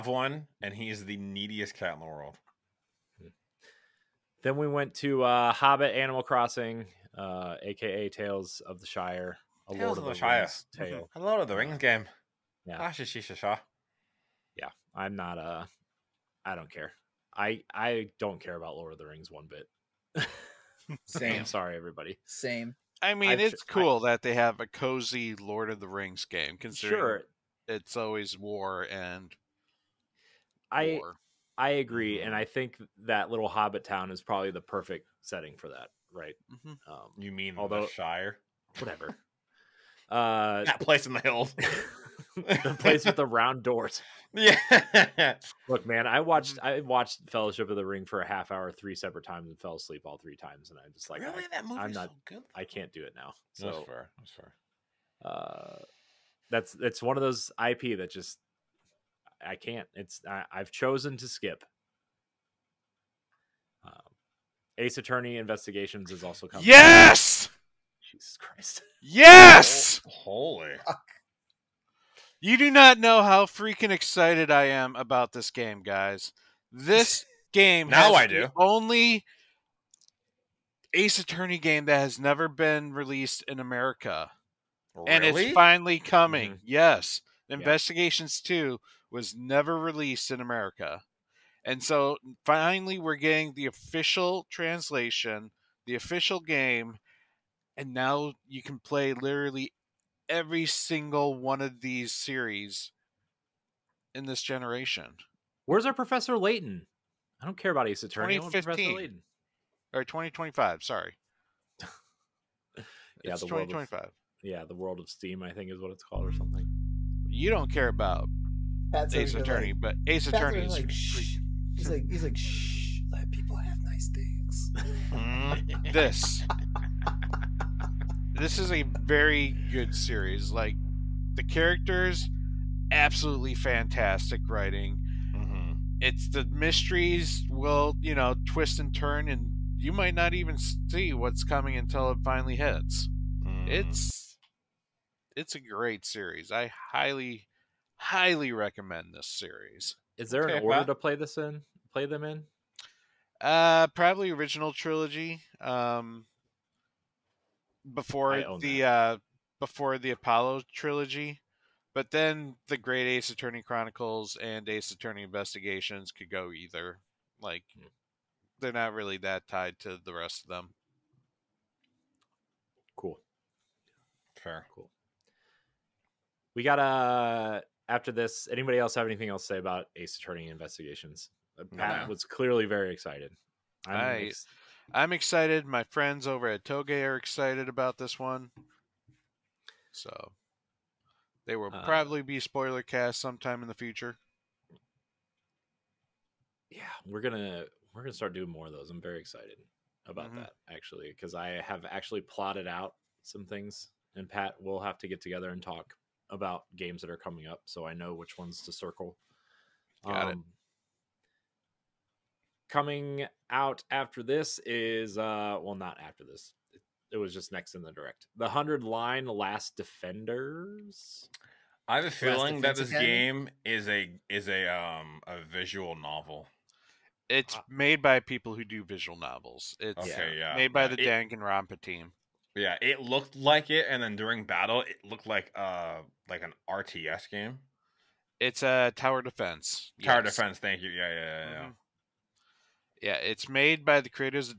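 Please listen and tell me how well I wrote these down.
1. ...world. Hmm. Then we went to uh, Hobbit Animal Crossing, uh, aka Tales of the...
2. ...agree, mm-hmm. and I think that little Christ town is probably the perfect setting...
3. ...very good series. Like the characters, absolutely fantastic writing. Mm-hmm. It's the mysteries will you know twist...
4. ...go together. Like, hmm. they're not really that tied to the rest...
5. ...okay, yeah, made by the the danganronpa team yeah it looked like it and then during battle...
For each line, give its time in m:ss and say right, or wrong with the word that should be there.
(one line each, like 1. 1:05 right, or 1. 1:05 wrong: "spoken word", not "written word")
1. 0:02 right
2. 0:31 wrong: "Hobbit", not "Christ"
3. 2:08 right
4. 2:46 wrong: "either", not "together"
5. 3:50 right.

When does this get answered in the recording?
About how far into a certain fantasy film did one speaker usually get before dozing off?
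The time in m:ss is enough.
0:48.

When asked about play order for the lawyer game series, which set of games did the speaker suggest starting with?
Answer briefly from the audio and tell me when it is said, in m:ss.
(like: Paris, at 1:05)
original trilogy, at 2:34.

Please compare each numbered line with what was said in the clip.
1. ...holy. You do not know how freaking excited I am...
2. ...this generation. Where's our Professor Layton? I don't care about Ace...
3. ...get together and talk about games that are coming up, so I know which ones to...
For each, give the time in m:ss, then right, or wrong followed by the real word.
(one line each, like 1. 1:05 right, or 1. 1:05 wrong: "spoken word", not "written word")
1. 1:10 right
2. 1:44 right
3. 3:25 right.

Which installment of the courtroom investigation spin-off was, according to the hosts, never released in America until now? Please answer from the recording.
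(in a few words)
Two.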